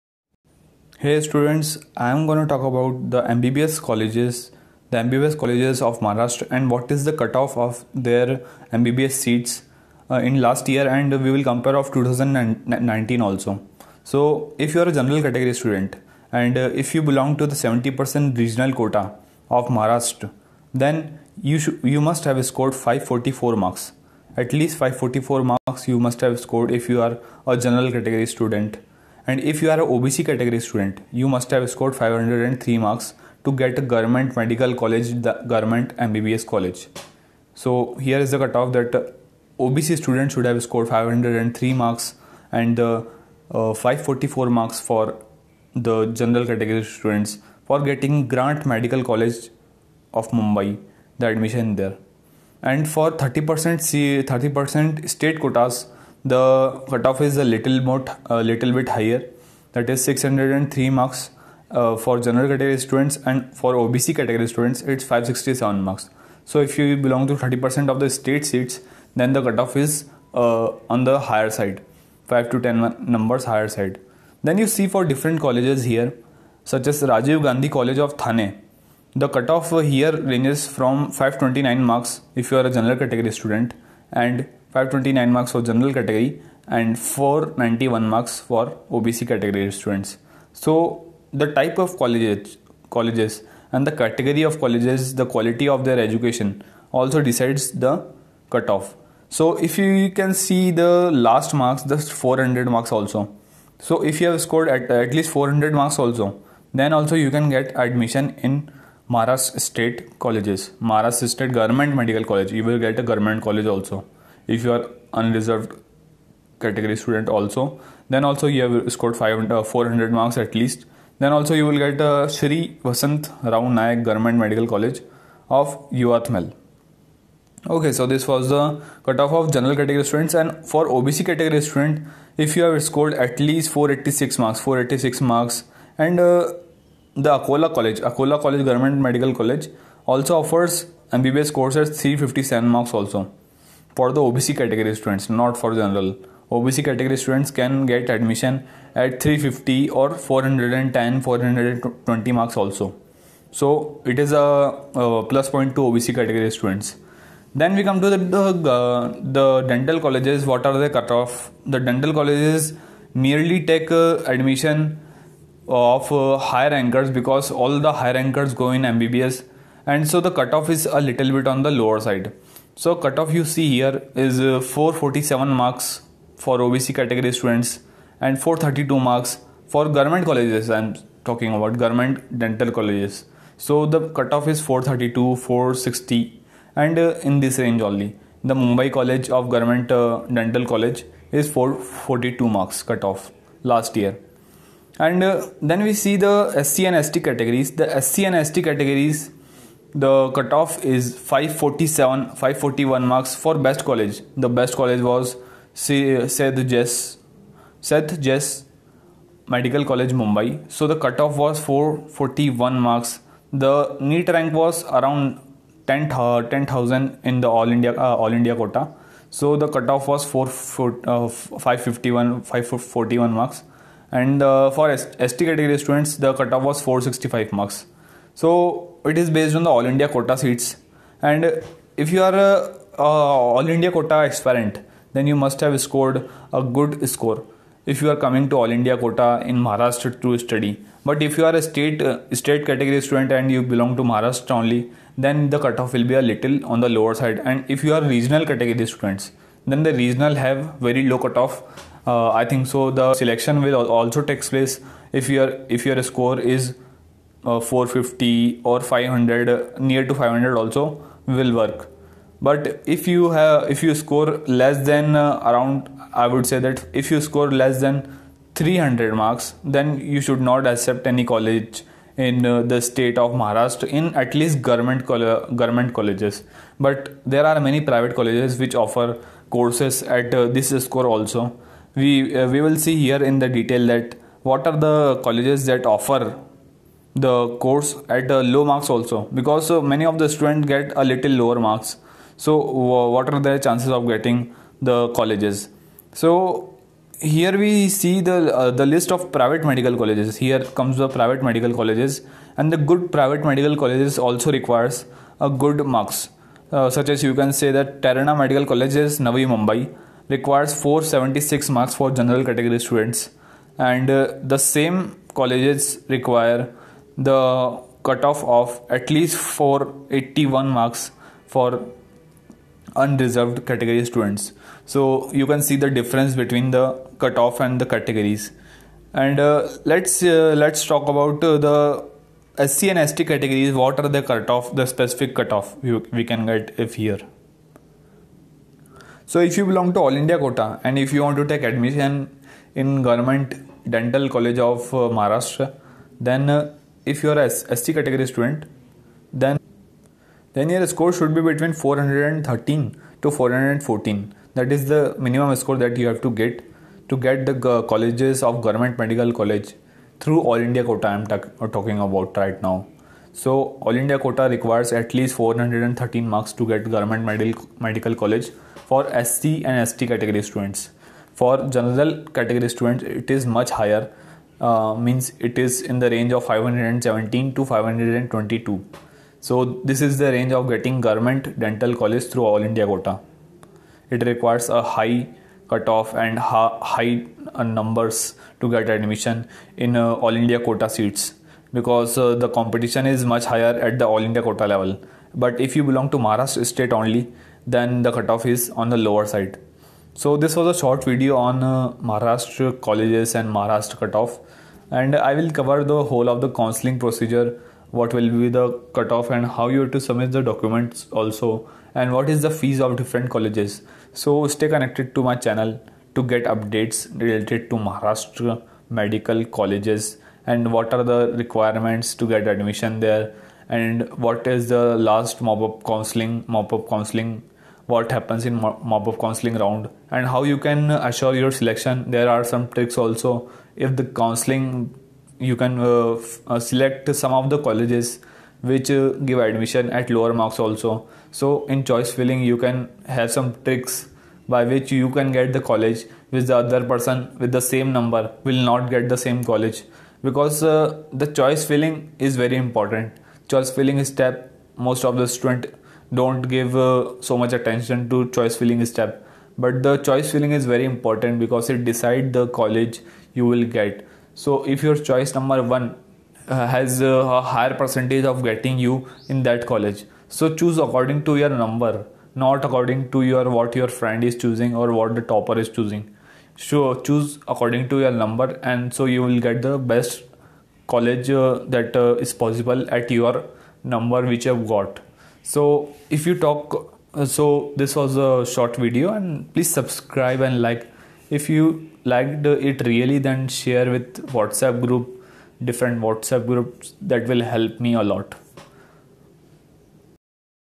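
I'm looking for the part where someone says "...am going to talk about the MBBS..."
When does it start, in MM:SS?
00:02.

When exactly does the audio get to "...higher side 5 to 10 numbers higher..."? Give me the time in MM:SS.
01:11.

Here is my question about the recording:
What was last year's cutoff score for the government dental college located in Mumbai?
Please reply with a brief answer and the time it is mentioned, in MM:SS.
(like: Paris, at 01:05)
442, at 03:11.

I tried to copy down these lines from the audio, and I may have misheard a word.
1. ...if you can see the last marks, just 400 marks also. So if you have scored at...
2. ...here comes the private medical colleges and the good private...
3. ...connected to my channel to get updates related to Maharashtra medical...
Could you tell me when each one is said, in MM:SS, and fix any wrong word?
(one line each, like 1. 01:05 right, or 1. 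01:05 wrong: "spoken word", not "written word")
1. 01:39 right
2. 05:00 right
3. 06:54 right.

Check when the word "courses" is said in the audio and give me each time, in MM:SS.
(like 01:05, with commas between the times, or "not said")
02:21, 04:39, 04:47.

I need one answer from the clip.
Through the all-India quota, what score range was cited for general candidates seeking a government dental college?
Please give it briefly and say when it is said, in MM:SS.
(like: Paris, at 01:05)
517 to 522, at 06:16.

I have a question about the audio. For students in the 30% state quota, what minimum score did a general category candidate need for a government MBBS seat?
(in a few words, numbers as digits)
603.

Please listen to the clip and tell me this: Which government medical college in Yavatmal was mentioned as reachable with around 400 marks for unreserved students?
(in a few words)
Shri Vasant Rao Nayak Government Medical College.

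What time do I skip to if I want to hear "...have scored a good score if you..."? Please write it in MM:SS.
03:55.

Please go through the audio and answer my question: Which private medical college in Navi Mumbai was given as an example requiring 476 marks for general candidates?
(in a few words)
Terna Medical College.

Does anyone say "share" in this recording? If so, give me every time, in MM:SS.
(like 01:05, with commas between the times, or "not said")
08:13.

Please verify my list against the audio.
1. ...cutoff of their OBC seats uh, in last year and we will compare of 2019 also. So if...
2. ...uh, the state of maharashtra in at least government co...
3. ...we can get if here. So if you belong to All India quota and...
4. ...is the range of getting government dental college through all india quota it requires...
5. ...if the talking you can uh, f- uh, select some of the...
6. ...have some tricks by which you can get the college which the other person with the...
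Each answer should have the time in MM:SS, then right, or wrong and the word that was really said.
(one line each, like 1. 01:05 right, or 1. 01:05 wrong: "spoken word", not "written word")
1. 00:07 wrong: "MBBS", not "OBC"
2. 04:32 right
3. 05:36 right
4. 06:20 right
5. 07:13 wrong: "counseling", not "talking"
6. 07:23 right.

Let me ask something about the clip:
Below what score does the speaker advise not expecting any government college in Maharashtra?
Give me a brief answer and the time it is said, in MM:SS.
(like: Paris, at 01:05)
300, at 04:28.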